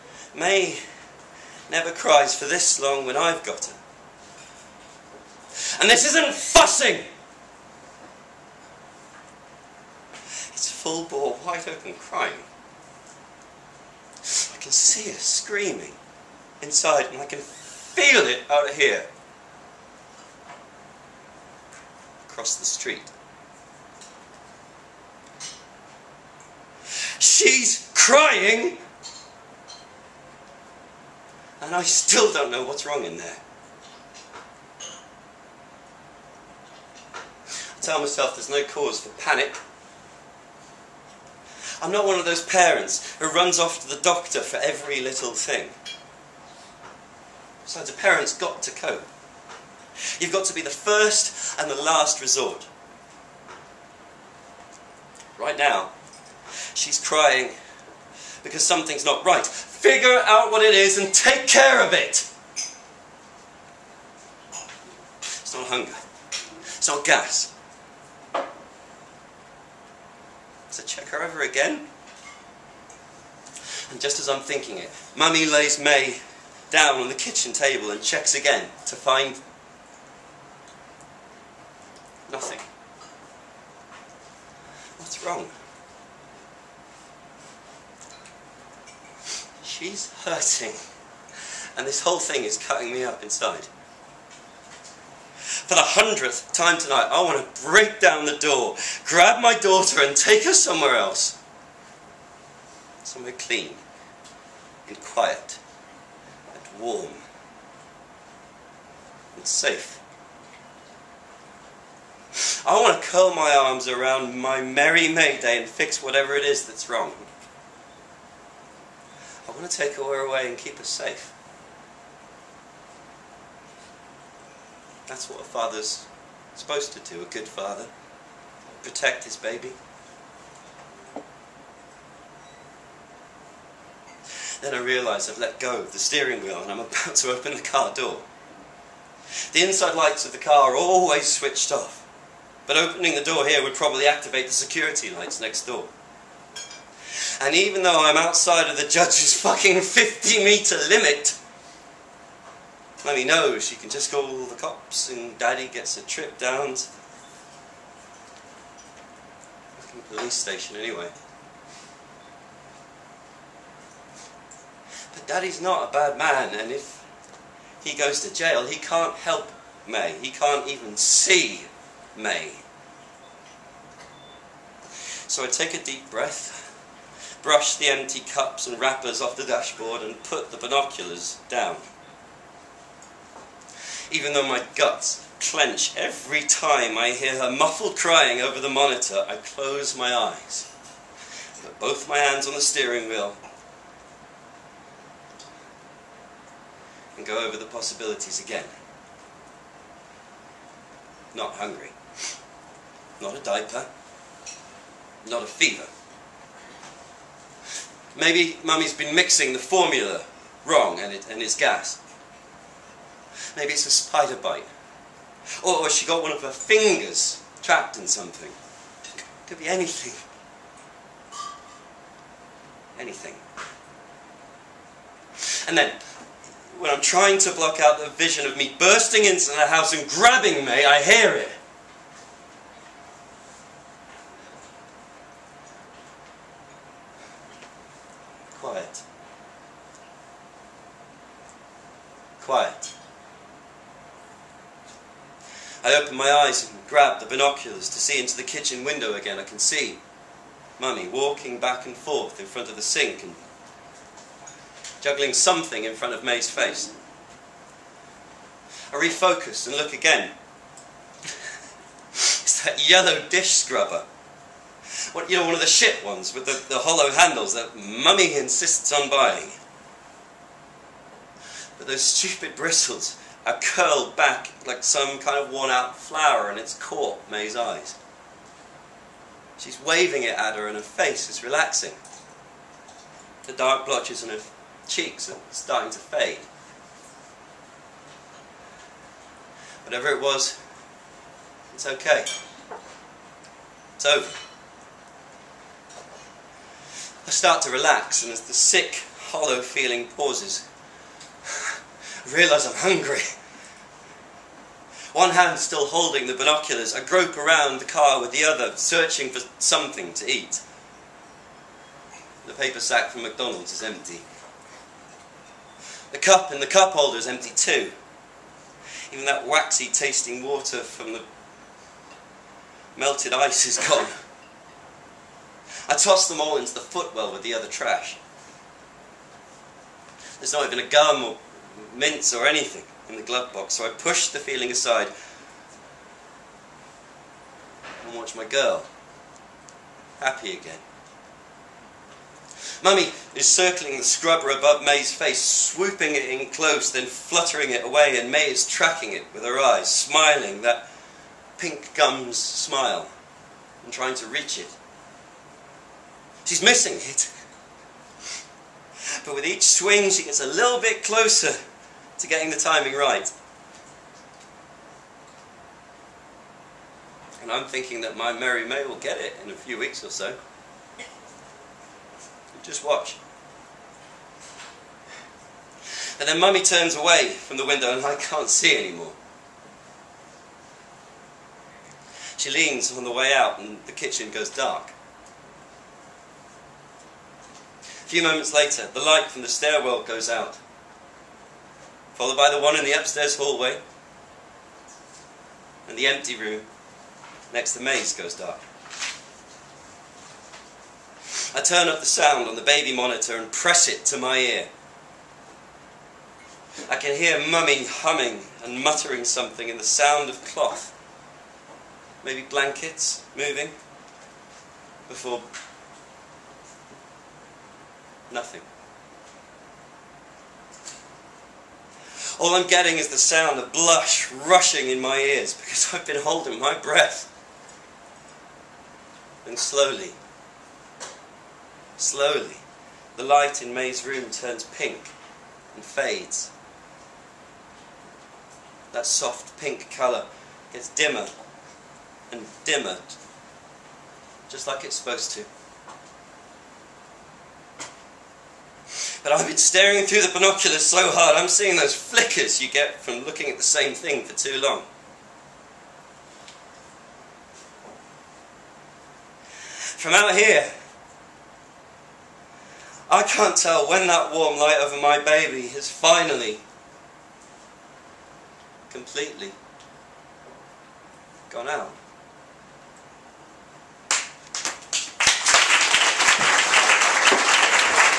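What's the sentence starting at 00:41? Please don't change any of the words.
I'm not one of those parents who runs off to the doctor for every little thing.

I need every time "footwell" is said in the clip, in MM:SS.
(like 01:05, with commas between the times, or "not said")
05:26.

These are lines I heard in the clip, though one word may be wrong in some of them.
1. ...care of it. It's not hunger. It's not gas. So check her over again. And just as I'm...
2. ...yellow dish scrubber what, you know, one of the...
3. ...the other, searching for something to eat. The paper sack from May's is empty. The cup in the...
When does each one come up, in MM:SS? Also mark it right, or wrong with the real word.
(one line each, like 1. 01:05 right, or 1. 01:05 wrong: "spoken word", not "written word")
1. 01:01 right
2. 04:22 right
3. 05:08 wrong: "McDonald", not "May".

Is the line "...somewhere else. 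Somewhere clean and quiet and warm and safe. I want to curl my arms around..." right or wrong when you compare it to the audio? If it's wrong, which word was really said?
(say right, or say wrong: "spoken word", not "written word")
right.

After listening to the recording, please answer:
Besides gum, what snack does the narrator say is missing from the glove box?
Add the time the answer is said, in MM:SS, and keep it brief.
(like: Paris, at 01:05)
Mints, at 05:31.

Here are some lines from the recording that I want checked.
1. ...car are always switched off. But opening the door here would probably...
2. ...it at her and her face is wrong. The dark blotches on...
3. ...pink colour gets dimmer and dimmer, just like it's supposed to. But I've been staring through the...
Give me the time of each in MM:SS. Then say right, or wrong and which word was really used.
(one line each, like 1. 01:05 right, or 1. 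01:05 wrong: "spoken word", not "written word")
1. 02:20 right
2. 04:40 wrong: "relaxing", not "wrong"
3. 07:19 right.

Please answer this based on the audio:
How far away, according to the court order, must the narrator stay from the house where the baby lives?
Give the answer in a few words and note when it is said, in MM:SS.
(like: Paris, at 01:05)
50 metres, at 02:29.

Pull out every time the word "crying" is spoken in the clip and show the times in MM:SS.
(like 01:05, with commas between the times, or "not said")
00:11, 00:27, 00:57, 03:07.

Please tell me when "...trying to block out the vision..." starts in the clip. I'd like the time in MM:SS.
03:46.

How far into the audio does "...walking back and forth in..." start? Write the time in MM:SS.
04:11.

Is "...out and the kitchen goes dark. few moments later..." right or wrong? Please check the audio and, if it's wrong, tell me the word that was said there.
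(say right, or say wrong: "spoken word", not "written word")
right.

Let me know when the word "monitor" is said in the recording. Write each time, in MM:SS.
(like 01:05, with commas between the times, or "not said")
03:08, 06:42.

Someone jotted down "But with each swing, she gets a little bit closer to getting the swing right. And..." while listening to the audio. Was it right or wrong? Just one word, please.
wrong.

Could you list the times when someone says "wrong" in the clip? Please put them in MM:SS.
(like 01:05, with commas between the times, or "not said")
00:32, 01:25, 01:56, 03:30.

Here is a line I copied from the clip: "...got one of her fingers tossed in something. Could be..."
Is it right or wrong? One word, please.
wrong.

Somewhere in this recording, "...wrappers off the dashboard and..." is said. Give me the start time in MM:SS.
02:58.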